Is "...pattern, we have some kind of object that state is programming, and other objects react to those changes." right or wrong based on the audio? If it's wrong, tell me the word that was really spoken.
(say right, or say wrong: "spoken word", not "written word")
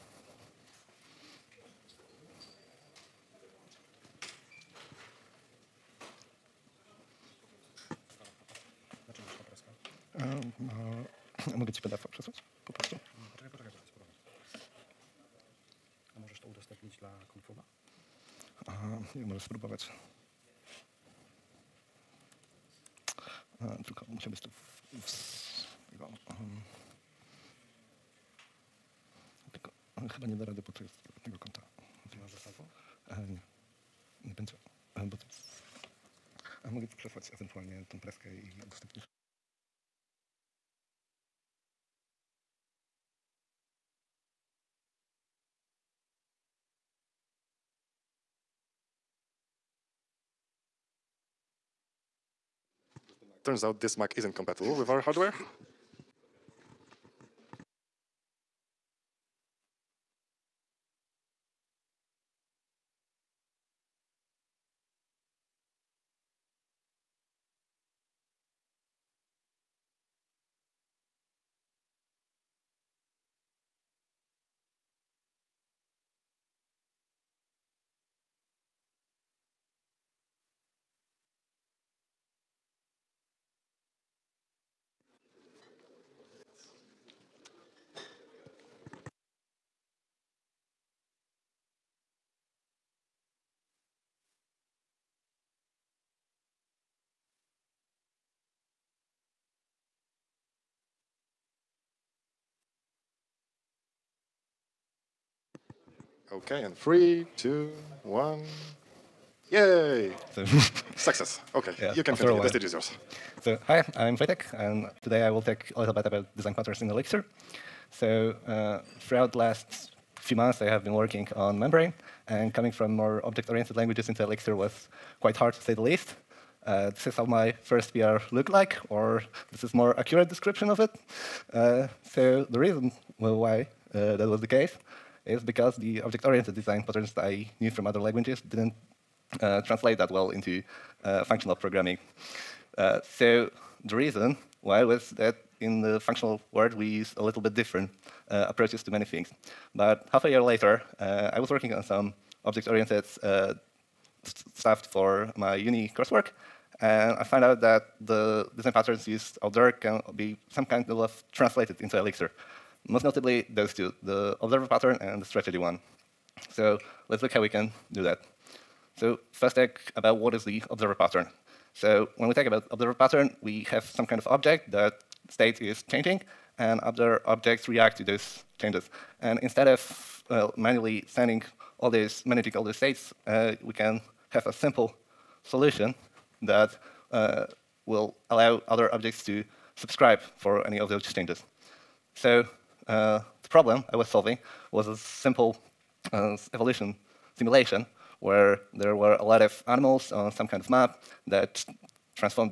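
wrong: "changing", not "programming".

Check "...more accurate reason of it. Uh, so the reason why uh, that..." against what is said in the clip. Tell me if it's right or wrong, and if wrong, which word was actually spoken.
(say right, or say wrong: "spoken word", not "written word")
wrong: "description", not "reason".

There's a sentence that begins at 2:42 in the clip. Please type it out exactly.
Most notably, those two, the observer pattern and the strategy one.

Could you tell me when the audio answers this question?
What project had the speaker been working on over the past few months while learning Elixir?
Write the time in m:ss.
2:01.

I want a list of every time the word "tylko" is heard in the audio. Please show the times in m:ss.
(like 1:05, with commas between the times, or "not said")
0:23, 0:29.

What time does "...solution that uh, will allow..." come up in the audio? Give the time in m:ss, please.
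3:05.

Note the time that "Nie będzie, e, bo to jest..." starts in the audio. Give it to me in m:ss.
0:34.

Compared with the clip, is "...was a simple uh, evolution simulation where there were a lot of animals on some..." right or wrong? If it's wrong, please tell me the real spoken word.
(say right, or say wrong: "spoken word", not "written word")
right.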